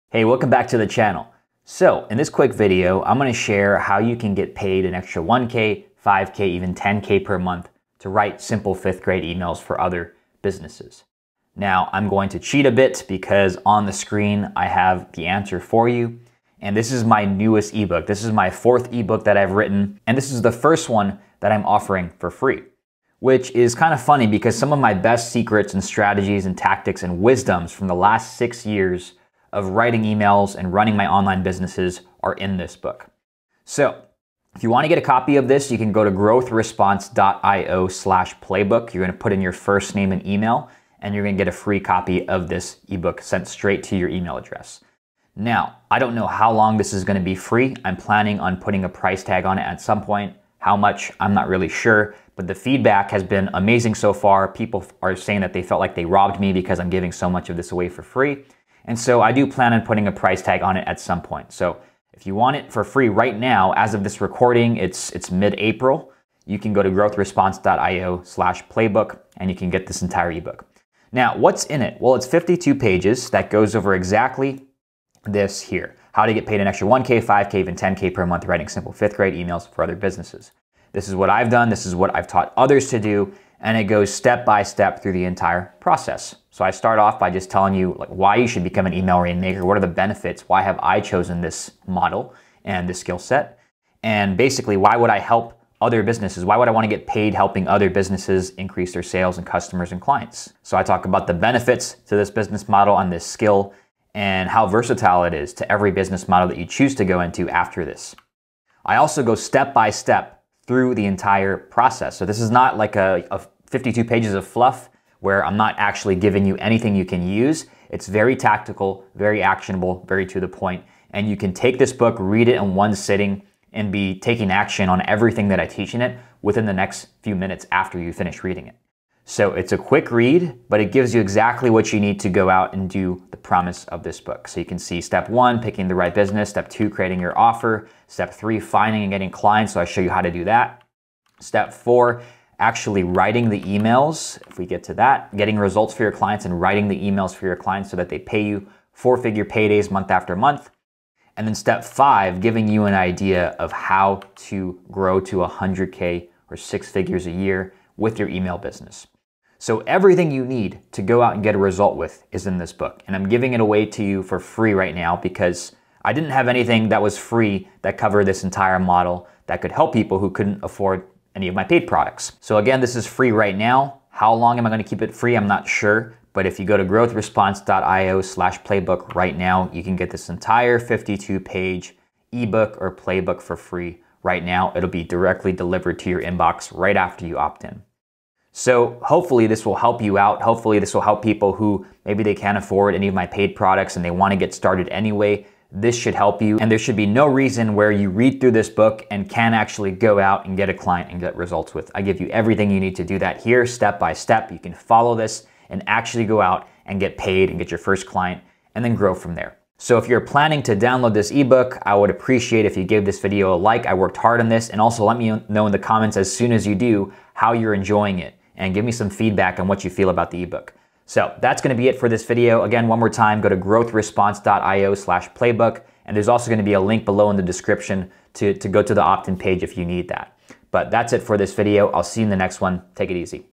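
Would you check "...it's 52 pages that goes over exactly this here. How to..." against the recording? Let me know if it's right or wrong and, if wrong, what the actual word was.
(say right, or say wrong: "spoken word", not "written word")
right.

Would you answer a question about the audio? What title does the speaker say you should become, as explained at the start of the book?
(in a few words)
email rainmaker.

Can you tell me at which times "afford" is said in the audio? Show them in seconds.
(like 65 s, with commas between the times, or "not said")
170 s, 192 s.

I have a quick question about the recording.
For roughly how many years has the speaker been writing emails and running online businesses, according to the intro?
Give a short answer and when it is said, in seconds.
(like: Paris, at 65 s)
6, at 28 s.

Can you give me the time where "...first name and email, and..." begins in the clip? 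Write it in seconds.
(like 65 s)
39 s.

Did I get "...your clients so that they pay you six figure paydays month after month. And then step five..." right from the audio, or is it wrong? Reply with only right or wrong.
wrong.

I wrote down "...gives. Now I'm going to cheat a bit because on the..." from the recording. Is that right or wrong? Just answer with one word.
wrong.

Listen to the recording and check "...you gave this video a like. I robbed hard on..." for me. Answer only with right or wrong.
wrong.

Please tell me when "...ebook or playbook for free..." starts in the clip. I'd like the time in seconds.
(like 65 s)
182 s.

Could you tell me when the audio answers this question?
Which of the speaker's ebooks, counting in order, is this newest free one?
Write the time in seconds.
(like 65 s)
18 s.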